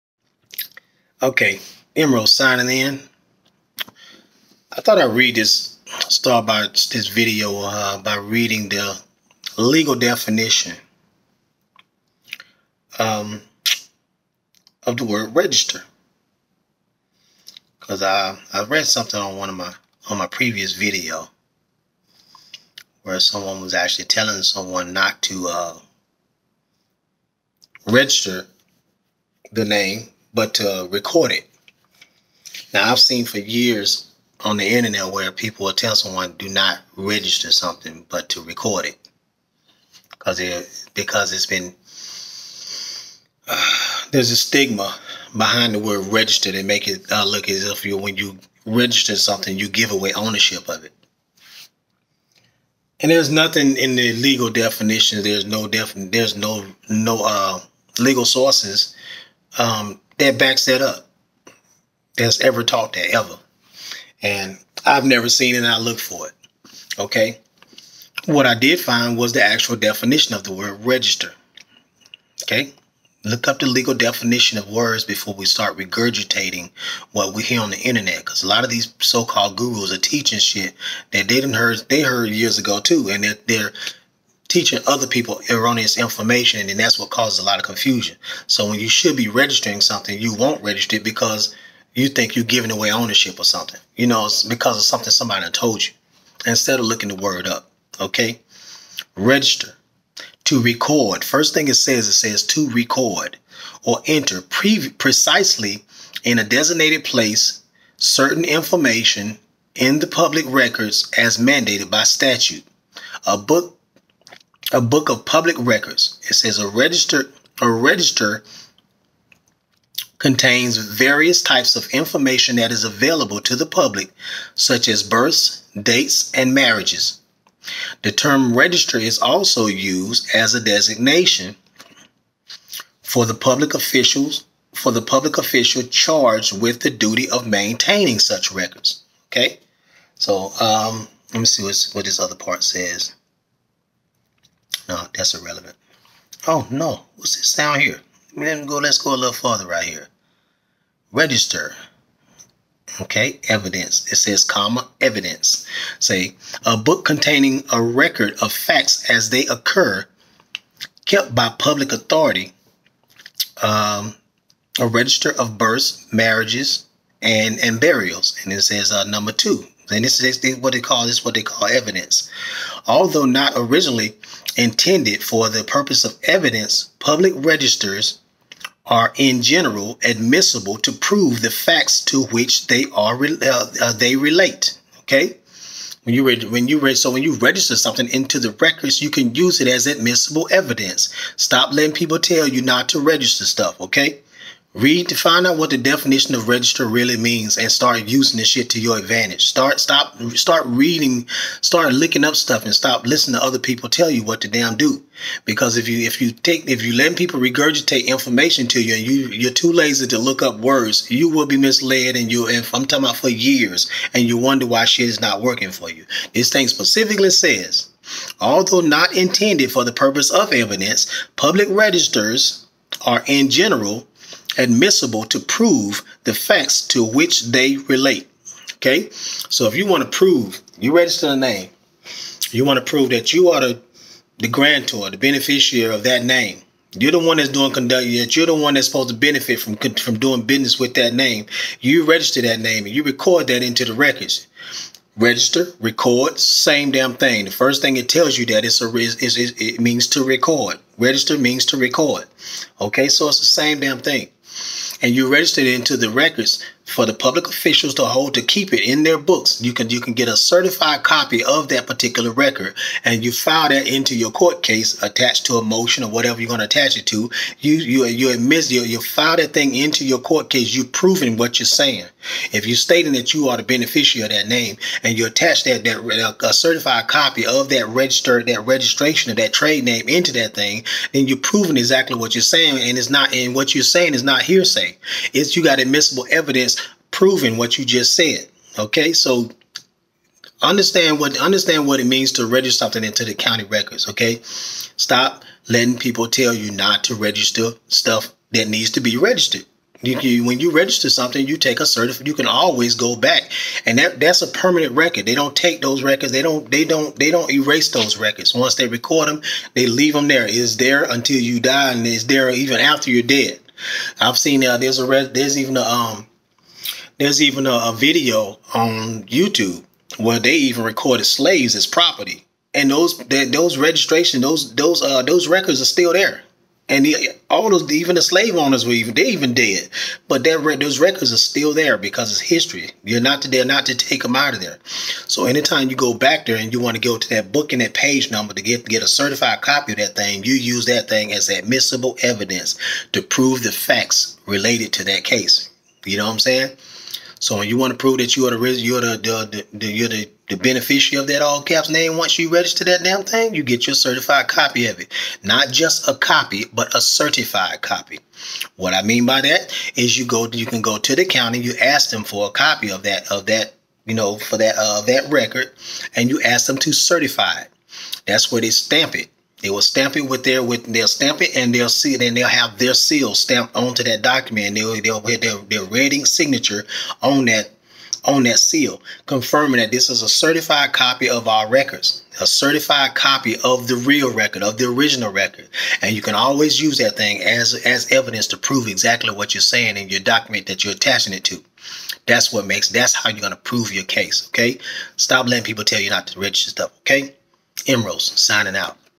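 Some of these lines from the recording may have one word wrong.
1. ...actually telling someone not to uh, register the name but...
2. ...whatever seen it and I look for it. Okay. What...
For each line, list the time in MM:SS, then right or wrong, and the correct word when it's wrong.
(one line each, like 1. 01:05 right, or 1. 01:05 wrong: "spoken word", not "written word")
1. 00:23 right
2. 01:05 wrong: "never", not "whatever".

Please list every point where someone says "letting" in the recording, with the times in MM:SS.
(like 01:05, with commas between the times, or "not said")
03:11, 04:55, 06:35.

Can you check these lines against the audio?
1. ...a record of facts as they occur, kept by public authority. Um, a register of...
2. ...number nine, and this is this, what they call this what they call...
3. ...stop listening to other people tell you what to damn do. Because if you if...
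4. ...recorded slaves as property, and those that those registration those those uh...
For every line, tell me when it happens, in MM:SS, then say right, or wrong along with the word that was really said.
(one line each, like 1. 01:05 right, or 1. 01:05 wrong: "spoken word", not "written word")
1. 02:37 right
2. 02:49 wrong: "two", not "nine"
3. 03:22 right
4. 05:20 right.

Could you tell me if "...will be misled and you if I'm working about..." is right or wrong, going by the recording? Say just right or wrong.
wrong.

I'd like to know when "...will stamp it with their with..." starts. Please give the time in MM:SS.
06:09.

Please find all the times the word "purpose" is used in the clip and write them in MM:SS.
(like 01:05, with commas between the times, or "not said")
02:55, 03:39.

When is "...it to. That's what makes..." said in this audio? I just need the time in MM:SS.
06:31.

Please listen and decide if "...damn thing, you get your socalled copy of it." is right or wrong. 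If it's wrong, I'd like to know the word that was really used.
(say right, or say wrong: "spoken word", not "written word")
wrong: "certified", not "socalled".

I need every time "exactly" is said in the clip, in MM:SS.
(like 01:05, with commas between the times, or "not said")
04:41, 06:28.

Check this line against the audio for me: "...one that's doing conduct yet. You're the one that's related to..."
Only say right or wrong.
wrong.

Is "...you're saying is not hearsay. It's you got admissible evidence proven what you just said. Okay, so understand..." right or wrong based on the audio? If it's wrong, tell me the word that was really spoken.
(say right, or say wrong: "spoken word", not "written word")
right.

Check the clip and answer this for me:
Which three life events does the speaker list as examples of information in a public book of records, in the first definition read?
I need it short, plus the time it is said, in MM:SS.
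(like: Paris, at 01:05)
births, dates, and marriages, at 02:05.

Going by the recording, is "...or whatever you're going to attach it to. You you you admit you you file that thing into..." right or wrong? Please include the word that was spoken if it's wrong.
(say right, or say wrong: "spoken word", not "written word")
right.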